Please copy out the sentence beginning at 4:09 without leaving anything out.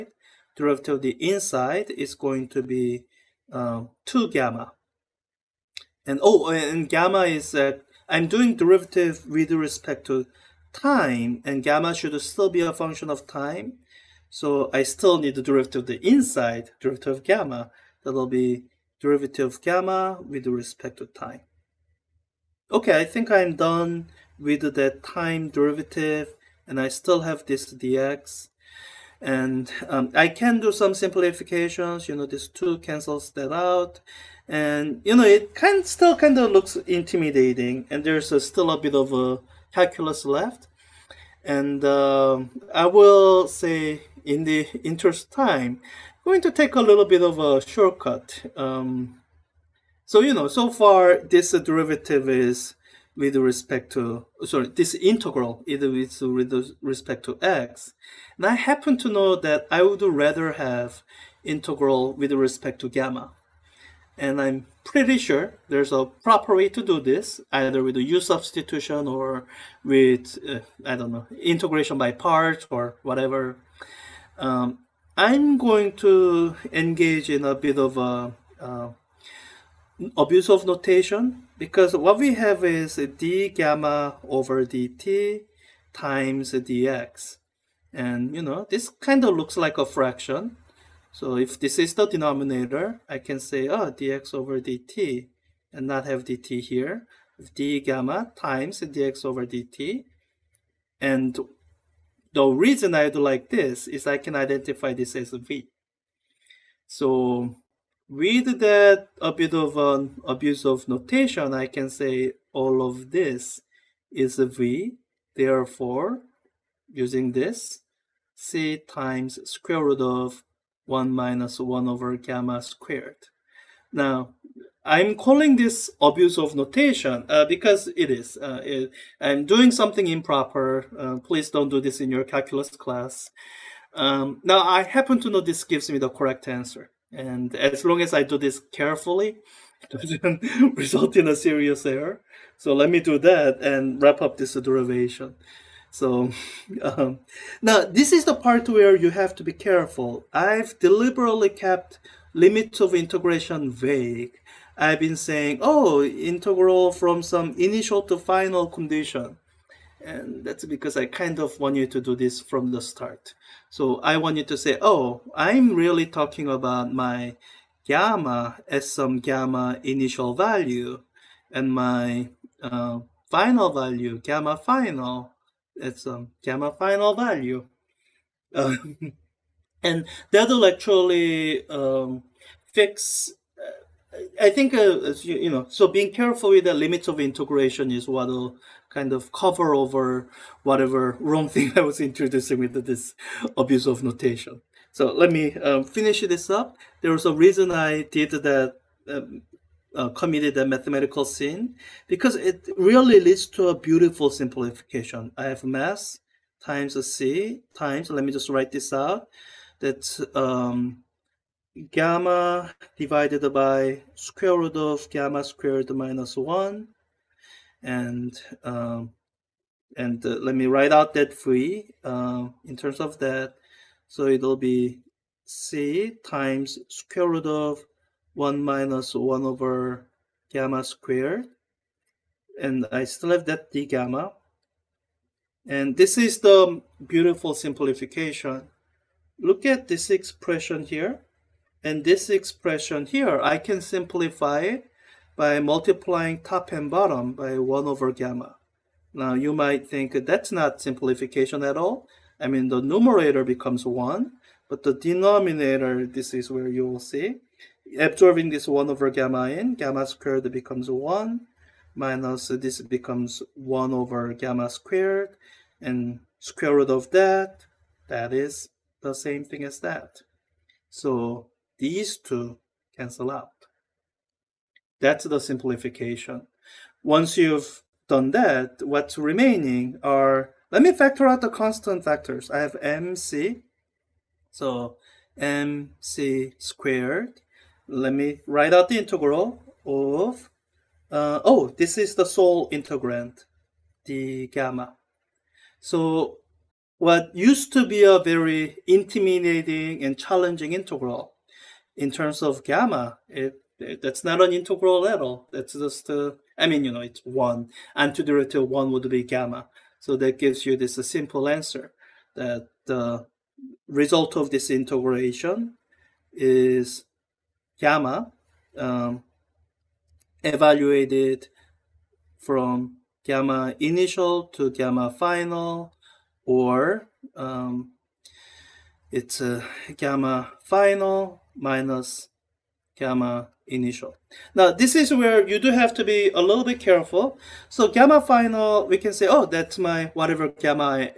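Now you might think that's not simplification at all.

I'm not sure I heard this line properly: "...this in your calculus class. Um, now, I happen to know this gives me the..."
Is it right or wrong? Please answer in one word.
right.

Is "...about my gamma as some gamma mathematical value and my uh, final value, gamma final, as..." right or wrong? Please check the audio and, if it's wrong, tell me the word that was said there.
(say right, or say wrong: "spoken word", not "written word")
wrong: "initial", not "mathematical".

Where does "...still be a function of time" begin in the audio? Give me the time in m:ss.
0:12.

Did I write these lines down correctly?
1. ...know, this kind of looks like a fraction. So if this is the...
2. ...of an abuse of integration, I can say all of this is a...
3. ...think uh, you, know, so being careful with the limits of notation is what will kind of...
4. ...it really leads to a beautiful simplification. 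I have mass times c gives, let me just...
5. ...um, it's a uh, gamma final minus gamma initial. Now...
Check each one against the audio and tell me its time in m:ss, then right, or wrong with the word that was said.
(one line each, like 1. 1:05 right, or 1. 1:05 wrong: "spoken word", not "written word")
1. 1:28 right
2. 1:49 wrong: "notation", not "integration"
3. 3:04 wrong: "integration", not "notation"
4. 3:22 wrong: "times", not "gives"
5. 5:27 right.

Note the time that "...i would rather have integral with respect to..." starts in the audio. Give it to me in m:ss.
0:59.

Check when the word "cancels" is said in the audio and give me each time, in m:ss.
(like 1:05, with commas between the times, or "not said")
0:32, 4:32.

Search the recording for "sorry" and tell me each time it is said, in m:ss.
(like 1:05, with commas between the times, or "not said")
0:54.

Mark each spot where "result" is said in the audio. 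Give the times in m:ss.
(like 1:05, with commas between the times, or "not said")
2:20, 5:13.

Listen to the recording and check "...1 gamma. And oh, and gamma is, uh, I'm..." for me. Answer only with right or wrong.
wrong.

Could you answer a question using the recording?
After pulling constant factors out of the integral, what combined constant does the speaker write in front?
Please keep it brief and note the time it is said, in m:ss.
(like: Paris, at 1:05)
mc squared, at 4:45.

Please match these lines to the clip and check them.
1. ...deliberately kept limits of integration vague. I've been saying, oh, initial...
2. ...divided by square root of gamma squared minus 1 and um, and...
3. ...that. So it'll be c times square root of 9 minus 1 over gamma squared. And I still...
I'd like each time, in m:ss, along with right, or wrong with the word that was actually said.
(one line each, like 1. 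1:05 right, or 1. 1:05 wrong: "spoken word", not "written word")
1. 2:30 wrong: "integral", not "initial"
2. 3:32 right
3. 3:43 wrong: "1", not "9".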